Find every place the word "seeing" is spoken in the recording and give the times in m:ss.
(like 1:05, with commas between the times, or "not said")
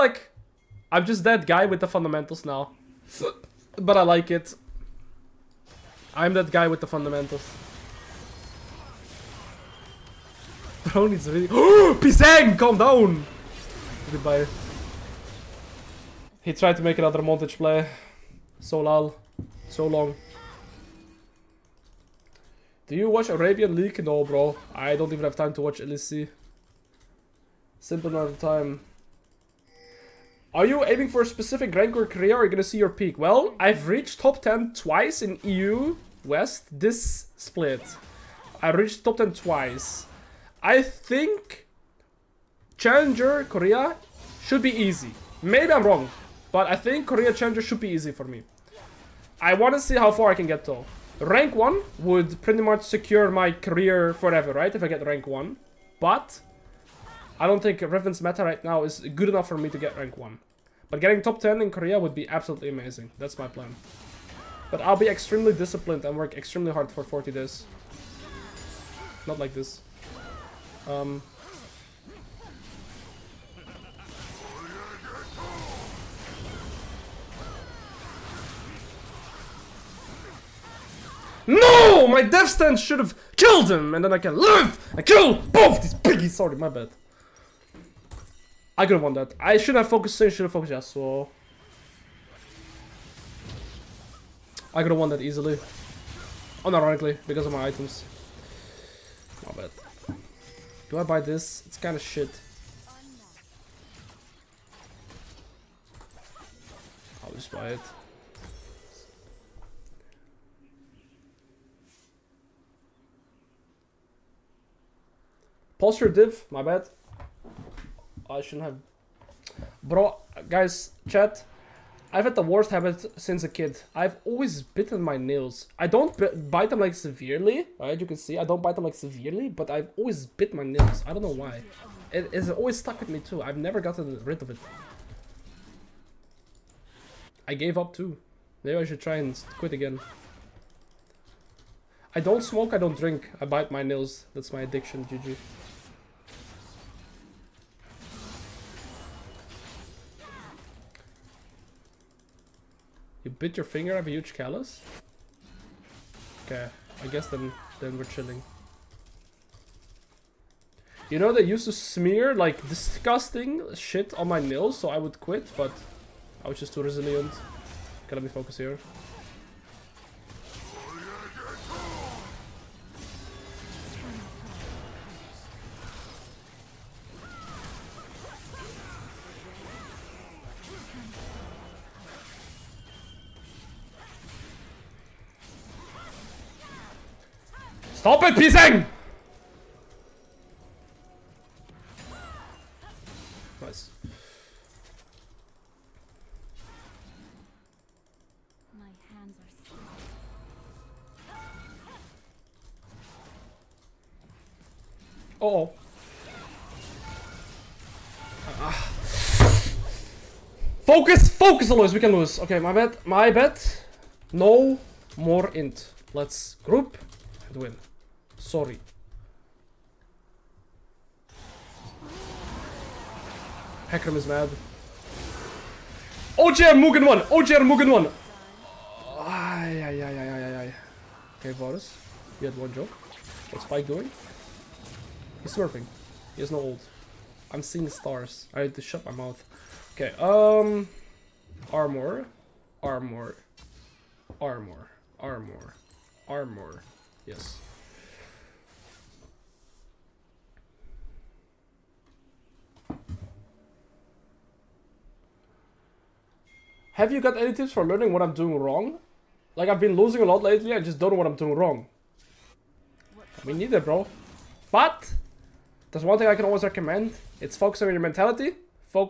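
3:57.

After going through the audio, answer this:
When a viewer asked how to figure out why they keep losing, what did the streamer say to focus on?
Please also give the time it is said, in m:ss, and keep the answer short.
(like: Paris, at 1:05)
Mentality, at 4:28.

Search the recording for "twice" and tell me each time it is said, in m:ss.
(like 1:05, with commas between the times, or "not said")
0:34, 0:39.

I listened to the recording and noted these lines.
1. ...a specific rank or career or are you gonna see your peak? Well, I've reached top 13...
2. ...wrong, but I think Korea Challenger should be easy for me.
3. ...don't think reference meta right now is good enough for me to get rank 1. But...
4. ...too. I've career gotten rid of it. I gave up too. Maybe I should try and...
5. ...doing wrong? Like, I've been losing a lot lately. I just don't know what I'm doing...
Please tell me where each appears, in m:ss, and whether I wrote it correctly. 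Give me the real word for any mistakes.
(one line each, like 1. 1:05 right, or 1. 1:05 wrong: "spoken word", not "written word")
1. 0:31 wrong: "10", not "13"
2. 0:45 right
3. 0:57 right
4. 2:13 wrong: "never", not "career"
5. 4:18 right.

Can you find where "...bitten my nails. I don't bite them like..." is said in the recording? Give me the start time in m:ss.
2:04.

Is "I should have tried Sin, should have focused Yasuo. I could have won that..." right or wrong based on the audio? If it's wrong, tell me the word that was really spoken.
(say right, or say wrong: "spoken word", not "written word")
wrong: "focused", not "tried".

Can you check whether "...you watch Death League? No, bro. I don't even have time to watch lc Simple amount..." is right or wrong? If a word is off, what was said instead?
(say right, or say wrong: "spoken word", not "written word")
wrong: "Arabian", not "Death".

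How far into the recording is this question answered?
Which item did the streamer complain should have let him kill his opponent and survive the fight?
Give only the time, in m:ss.
1:22.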